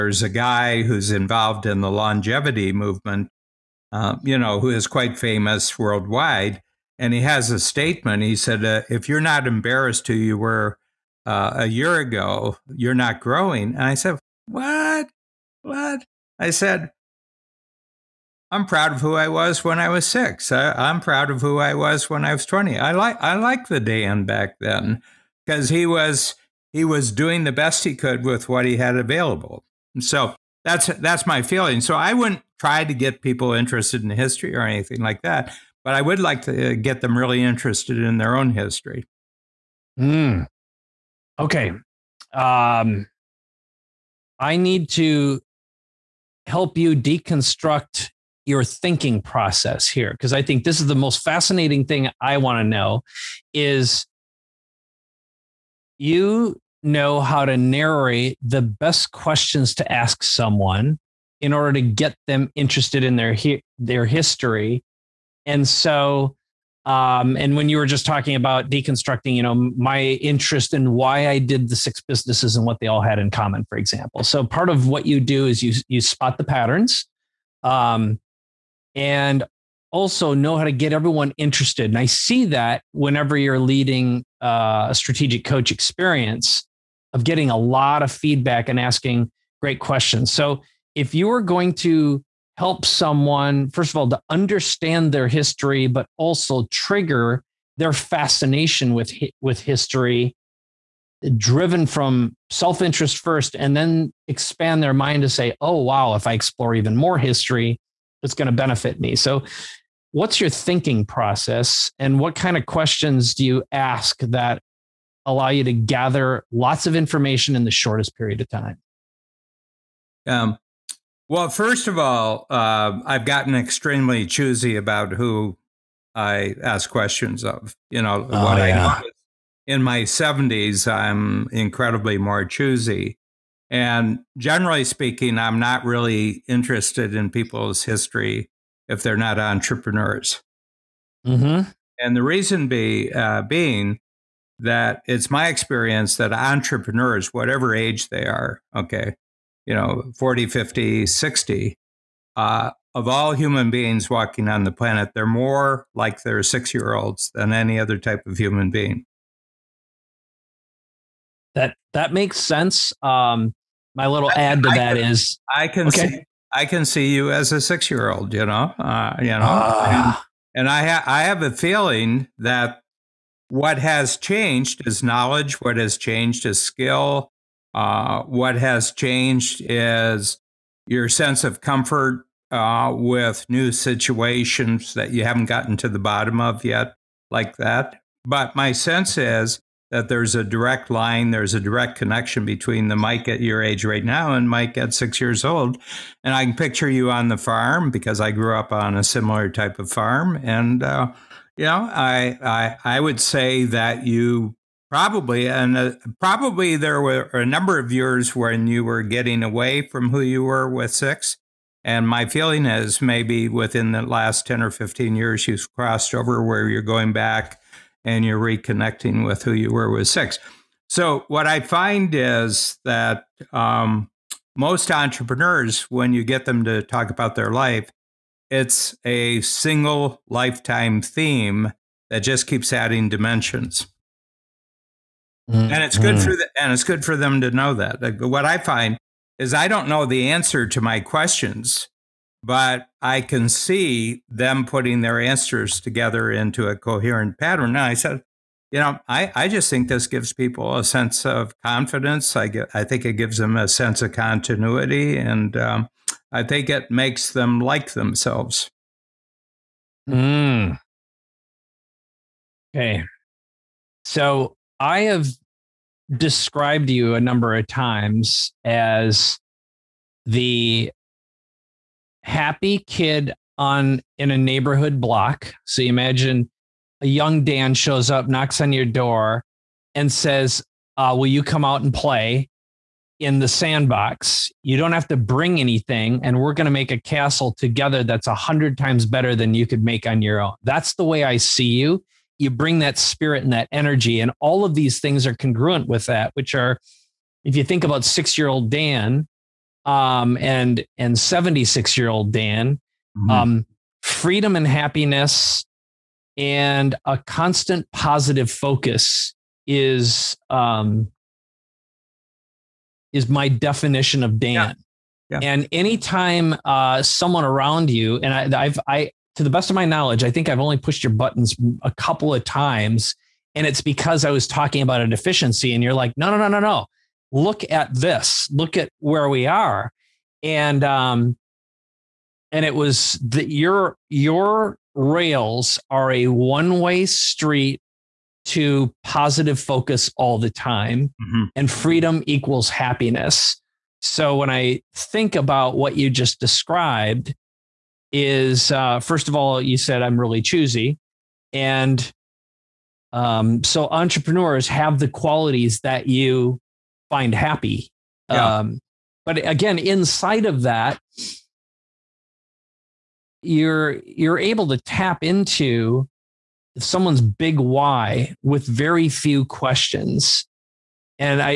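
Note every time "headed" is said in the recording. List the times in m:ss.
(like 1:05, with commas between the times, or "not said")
not said.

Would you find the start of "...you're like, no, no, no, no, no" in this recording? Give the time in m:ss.
5:25.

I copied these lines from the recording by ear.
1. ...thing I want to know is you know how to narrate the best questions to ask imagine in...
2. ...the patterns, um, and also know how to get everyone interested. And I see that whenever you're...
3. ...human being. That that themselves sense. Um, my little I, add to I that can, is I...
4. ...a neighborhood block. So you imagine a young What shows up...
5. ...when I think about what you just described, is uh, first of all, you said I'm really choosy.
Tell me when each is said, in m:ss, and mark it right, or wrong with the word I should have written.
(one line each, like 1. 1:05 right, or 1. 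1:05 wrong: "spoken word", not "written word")
1. 0:51 wrong: "someone", not "imagine"
2. 1:16 right
3. 2:38 wrong: "makes", not "themselves"
4. 4:34 wrong: "Dan", not "What"
5. 5:44 right.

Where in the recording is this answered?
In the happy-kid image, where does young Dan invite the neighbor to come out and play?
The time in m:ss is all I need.
4:43.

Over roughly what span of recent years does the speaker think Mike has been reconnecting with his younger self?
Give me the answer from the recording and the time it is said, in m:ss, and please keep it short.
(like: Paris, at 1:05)
10 or 15 years, at 3:34.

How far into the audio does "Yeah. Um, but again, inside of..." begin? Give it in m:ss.
5:58.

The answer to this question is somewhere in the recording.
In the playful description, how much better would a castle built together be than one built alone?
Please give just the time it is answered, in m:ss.
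4:48.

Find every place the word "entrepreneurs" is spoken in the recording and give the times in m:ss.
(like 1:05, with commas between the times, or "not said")
2:19, 2:26, 3:44, 5:53.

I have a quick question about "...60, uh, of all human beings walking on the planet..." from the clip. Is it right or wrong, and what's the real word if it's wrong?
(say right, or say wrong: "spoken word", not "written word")
right.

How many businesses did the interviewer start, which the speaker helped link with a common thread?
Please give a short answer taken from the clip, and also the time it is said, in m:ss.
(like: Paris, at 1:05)
6, at 1:11.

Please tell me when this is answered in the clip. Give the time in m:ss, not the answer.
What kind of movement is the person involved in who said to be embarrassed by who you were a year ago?
0:01.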